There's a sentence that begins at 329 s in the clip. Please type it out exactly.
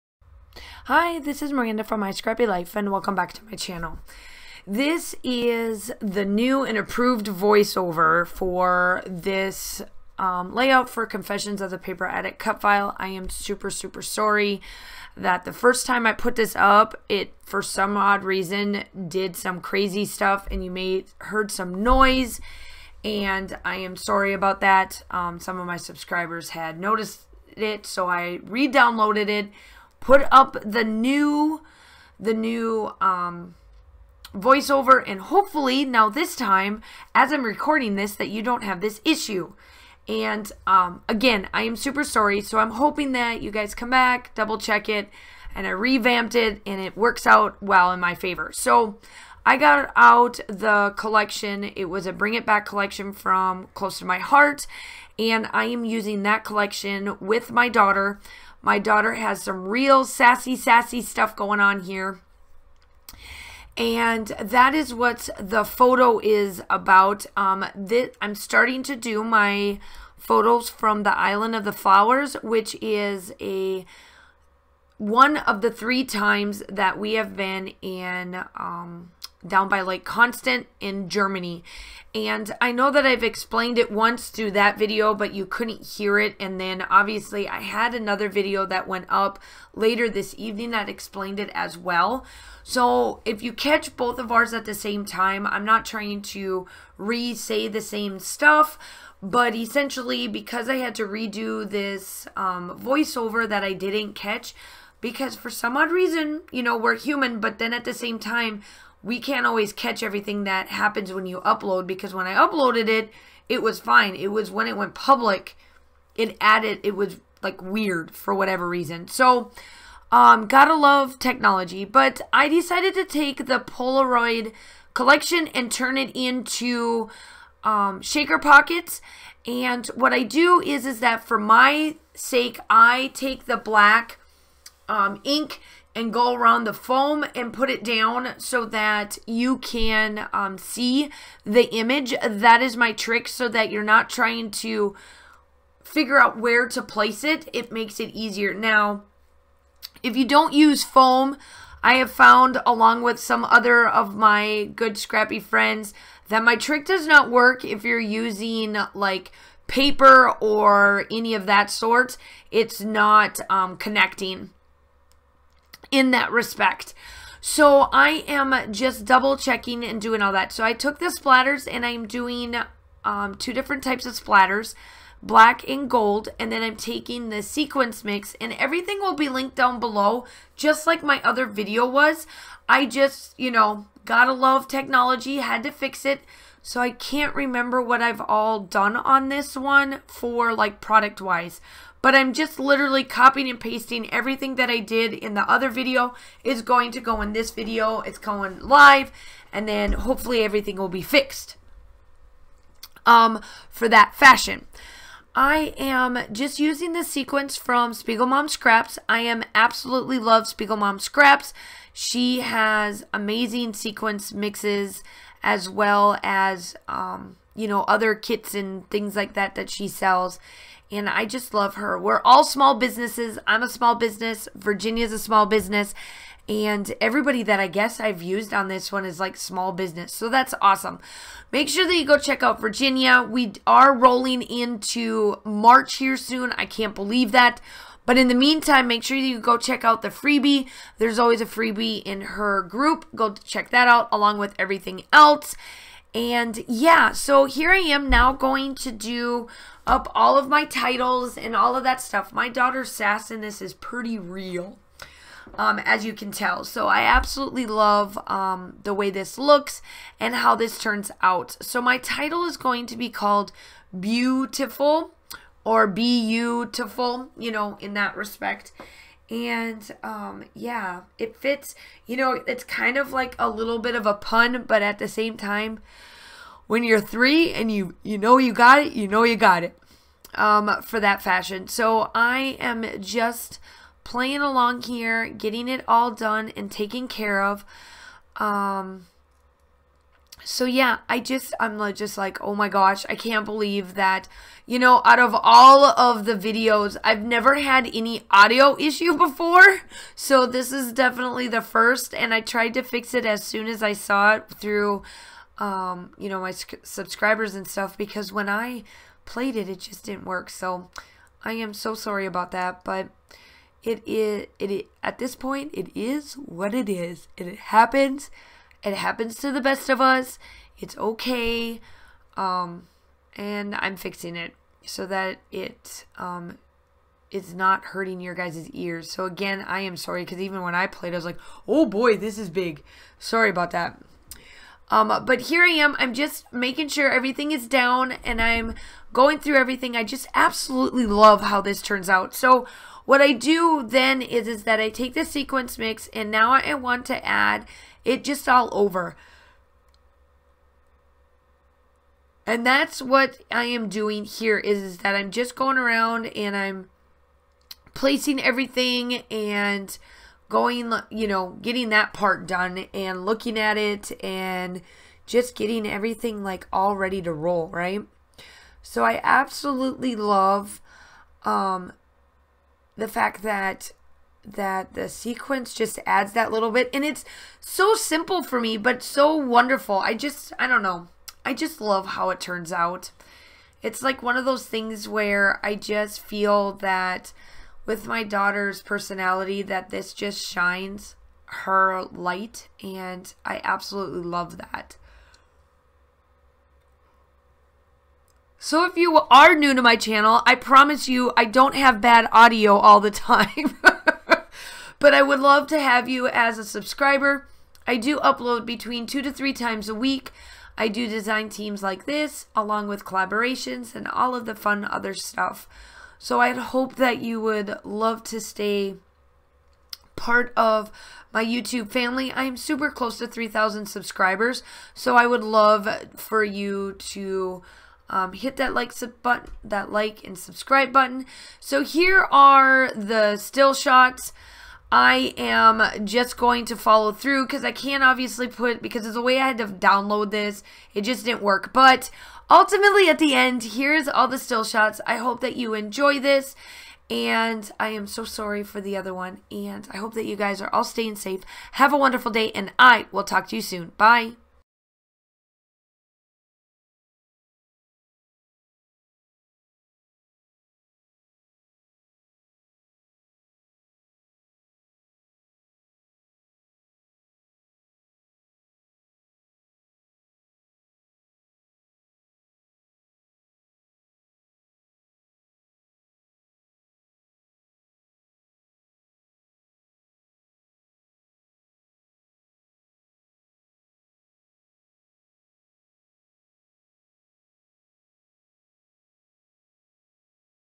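So again, I am sorry because even when I played, I was like, oh boy, this is big.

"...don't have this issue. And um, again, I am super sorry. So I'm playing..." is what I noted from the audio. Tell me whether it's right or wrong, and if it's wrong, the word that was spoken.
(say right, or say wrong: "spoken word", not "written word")
wrong: "hoping", not "playing".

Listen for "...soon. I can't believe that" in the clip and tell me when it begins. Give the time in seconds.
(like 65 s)
236 s.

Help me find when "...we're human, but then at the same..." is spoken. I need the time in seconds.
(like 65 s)
106 s.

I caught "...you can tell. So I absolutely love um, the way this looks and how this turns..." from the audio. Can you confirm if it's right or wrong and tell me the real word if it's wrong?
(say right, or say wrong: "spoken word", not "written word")
right.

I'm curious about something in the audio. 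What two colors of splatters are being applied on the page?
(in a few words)
black and gold.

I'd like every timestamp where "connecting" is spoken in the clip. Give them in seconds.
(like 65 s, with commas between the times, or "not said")
163 s.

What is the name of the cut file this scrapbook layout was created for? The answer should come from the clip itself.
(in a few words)
Confessions of the Paper Addict.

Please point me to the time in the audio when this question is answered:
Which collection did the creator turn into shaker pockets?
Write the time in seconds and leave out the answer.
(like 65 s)
123 s.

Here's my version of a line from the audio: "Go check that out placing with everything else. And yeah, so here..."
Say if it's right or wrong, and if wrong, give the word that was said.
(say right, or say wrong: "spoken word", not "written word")
wrong: "along", not "placing".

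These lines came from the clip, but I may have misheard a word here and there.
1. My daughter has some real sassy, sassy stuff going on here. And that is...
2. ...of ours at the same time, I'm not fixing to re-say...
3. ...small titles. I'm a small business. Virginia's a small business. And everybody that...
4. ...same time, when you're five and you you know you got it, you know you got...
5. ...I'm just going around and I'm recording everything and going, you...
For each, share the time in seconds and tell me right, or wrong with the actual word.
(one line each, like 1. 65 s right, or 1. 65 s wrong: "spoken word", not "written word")
1. 58 s right
2. 94 s wrong: "trying", not "fixing"
3. 222 s wrong: "businesses", not "titles"
4. 275 s wrong: "three", not "five"
5. 355 s wrong: "placing", not "recording".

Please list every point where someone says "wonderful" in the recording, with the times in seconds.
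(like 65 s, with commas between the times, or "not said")
379 s, 451 s.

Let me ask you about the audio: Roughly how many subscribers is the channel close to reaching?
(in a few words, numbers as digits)
3,000.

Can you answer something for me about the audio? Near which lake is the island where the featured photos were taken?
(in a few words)
Lake Constance.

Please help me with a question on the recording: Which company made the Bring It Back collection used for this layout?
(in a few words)
Close to My Heart.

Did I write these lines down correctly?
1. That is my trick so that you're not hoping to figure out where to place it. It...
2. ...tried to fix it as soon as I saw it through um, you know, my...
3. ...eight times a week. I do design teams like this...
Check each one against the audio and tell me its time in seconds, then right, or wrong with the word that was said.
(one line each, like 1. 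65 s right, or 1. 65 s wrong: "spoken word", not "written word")
1. 142 s wrong: "trying", not "hoping"
2. 302 s right
3. 409 s wrong: "three", not "eight".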